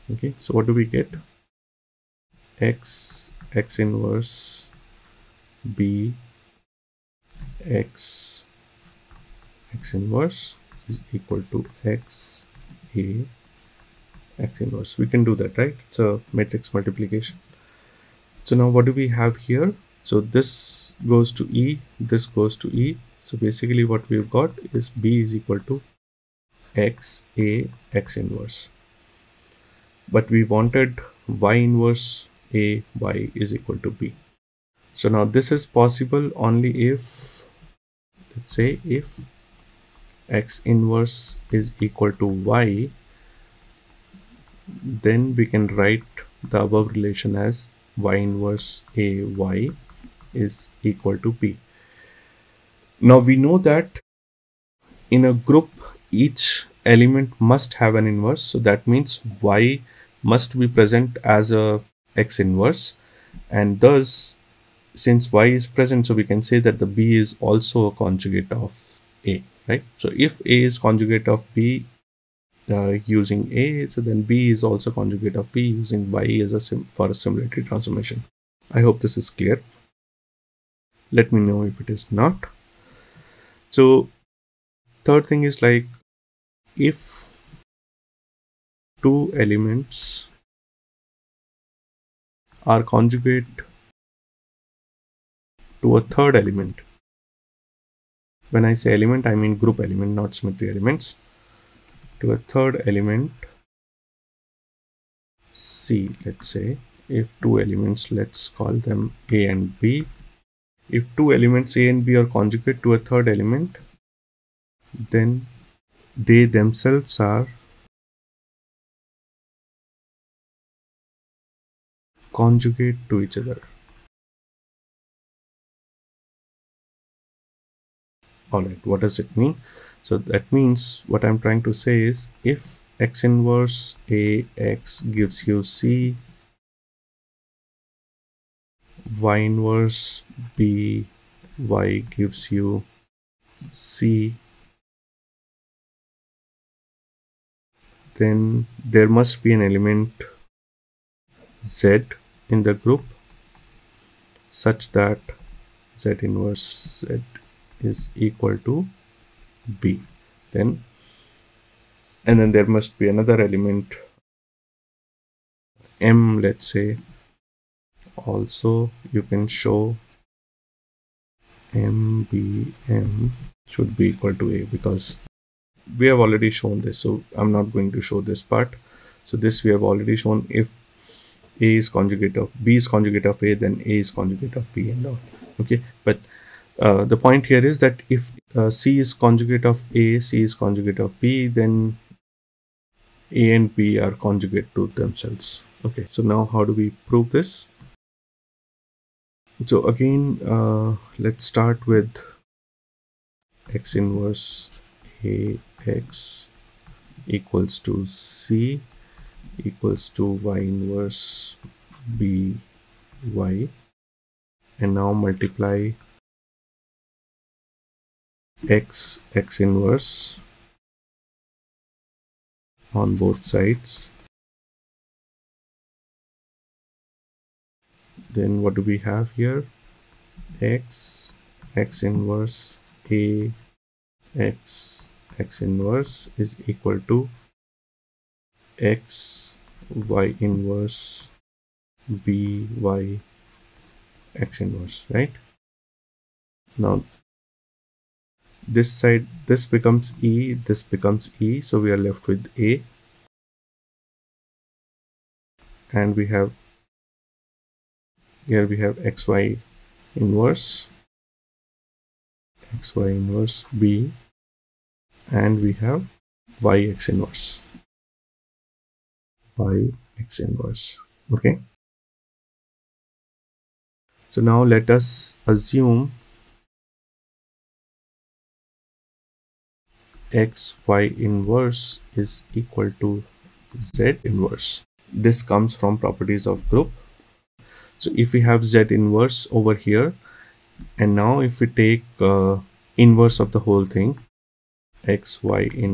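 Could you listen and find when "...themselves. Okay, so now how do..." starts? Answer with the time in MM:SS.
03:14.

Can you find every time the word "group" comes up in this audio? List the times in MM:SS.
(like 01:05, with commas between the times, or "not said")
00:55, 01:39, 02:32, 04:46.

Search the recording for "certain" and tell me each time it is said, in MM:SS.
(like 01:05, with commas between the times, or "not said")
not said.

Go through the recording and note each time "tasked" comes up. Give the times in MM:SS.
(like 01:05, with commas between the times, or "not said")
not said.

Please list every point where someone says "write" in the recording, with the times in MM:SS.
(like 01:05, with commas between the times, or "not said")
00:45.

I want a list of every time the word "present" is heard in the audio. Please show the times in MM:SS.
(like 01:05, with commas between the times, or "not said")
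01:00, 01:05.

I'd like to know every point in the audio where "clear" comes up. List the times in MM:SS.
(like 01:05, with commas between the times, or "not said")
01:19.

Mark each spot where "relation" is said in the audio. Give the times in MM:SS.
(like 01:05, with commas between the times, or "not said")
00:46.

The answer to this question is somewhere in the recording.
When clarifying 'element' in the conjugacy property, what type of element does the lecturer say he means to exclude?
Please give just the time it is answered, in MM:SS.
01:40.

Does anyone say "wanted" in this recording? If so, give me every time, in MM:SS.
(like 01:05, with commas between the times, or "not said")
00:30.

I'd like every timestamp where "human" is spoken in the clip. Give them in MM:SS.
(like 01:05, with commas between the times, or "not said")
not said.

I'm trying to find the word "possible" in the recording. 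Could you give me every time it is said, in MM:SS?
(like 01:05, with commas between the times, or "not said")
00:35.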